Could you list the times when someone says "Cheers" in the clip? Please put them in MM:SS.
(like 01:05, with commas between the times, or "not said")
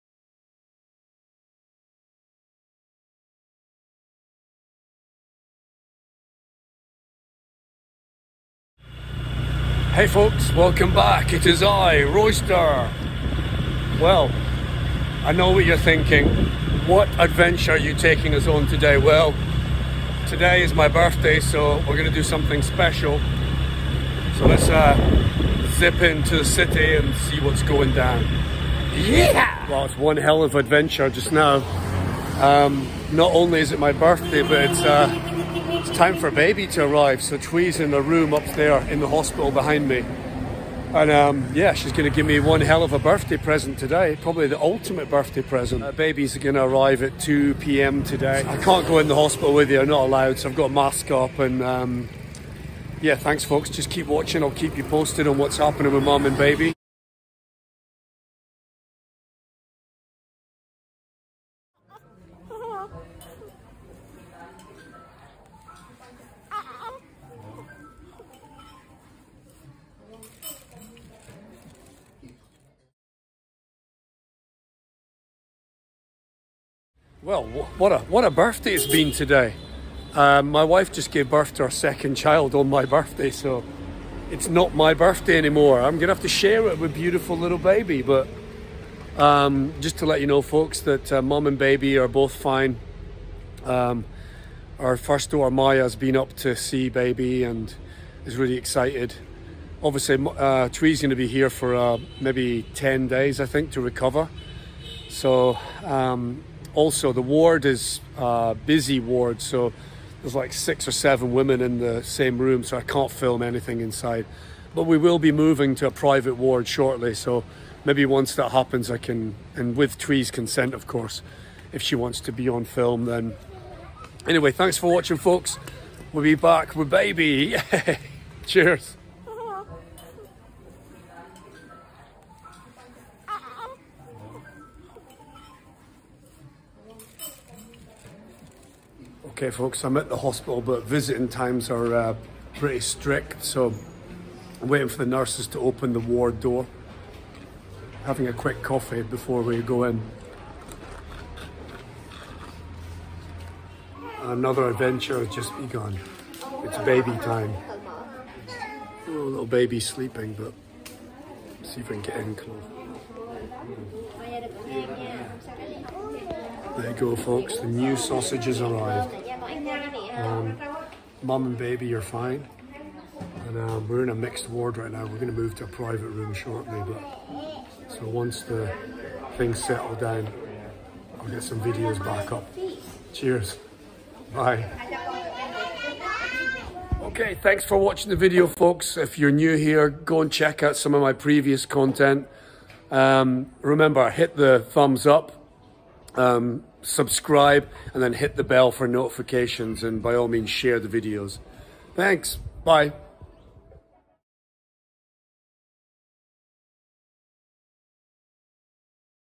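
02:08, 03:03.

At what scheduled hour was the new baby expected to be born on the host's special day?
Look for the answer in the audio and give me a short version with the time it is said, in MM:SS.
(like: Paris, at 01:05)
2 p.m., at 00:47.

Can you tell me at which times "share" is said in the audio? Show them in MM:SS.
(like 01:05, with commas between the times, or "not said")
01:26, 03:20.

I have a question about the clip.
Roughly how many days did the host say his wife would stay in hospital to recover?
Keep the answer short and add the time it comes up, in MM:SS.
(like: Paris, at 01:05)
10, at 01:42.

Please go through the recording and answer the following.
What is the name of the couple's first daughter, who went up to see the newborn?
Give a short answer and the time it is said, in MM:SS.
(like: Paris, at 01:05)
Maya, at 01:35.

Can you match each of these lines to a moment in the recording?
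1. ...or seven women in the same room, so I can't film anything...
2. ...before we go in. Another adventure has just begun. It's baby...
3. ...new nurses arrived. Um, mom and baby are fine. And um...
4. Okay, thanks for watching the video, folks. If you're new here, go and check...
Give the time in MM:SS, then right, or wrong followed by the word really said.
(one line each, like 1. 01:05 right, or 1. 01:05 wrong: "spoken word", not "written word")
1. 01:50 right
2. 02:29 right
3. 02:47 wrong: "sausages", not "nurses"
4. 03:07 right.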